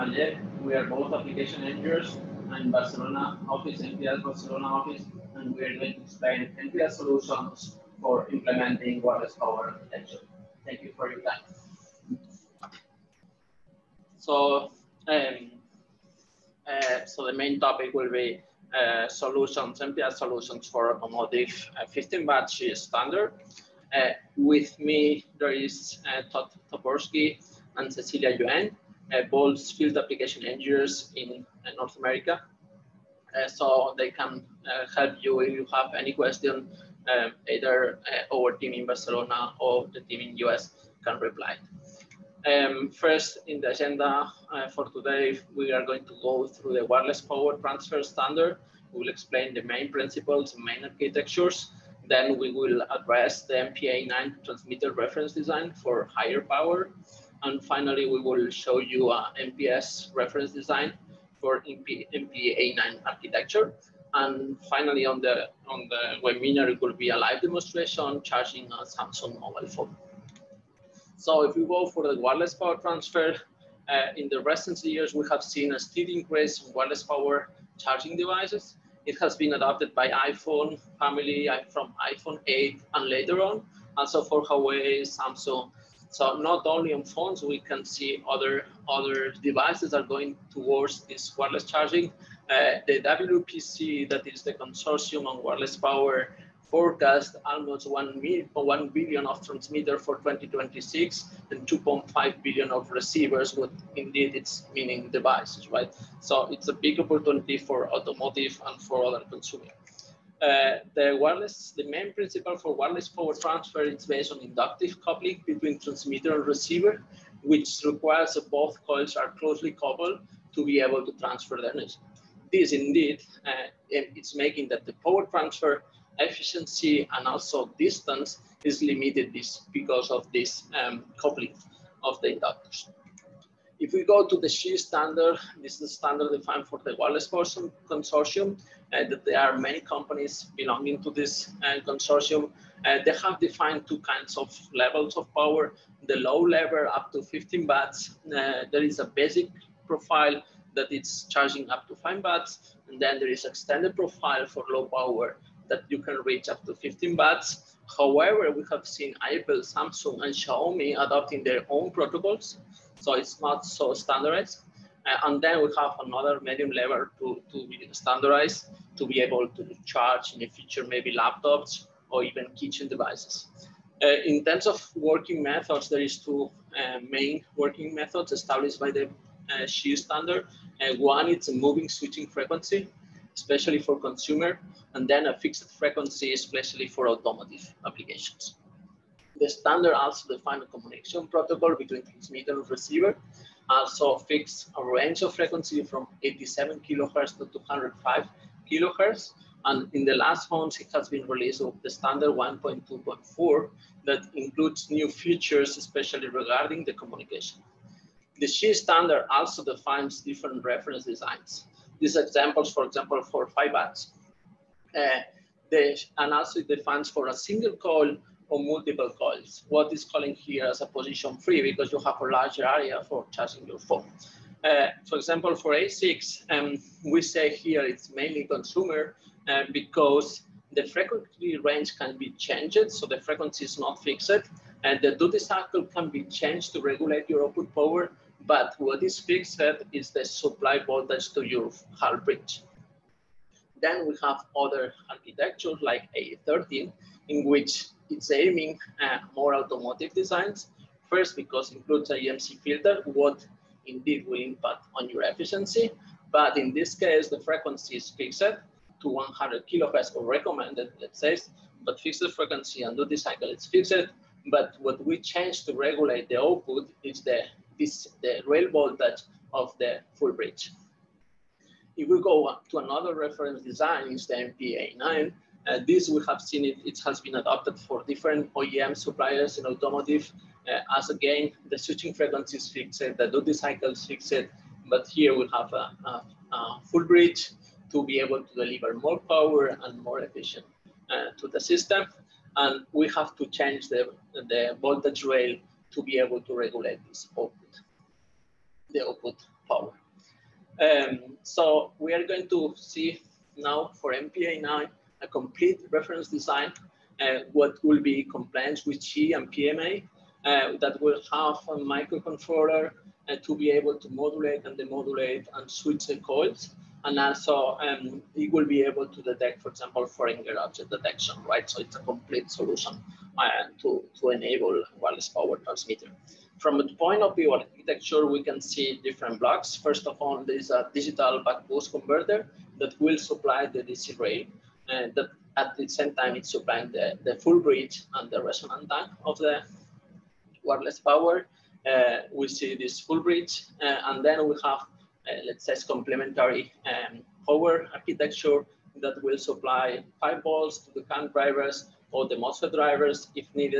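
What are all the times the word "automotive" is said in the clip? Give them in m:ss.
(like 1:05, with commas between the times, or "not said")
1:47, 3:07, 4:09, 4:39.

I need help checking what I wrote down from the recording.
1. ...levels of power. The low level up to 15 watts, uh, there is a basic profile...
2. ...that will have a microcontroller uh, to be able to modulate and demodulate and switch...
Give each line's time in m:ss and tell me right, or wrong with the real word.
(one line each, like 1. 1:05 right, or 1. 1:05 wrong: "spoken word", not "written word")
1. 2:24 right
2. 5:10 right.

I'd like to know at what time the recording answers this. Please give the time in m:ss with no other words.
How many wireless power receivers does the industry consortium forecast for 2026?
1:41.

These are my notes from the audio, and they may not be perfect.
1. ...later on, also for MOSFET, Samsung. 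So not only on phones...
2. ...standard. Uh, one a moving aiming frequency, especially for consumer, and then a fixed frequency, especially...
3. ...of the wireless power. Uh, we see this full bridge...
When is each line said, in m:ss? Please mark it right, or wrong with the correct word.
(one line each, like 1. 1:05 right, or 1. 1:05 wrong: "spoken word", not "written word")
1. 1:23 wrong: "Huawei", not "MOSFET"
2. 2:59 wrong: "switching", not "aiming"
3. 5:39 right.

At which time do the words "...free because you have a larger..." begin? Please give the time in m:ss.
3:41.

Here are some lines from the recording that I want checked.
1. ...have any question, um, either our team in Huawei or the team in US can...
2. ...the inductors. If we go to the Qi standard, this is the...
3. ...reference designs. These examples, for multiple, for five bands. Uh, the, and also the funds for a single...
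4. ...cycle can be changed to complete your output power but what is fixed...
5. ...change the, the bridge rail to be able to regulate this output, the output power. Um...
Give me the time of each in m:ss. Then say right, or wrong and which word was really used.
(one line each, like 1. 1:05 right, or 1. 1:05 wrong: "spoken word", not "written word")
1. 0:35 wrong: "Barcelona", not "Huawei"
2. 2:12 right
3. 3:30 wrong: "example", not "multiple"
4. 3:55 wrong: "regulate", not "complete"
5. 4:53 wrong: "voltage", not "bridge".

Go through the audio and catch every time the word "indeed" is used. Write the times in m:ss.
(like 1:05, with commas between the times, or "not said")
1:43, 2:02, 4:13.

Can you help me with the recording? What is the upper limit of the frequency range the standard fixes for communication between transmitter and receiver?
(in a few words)
205 kilohertz.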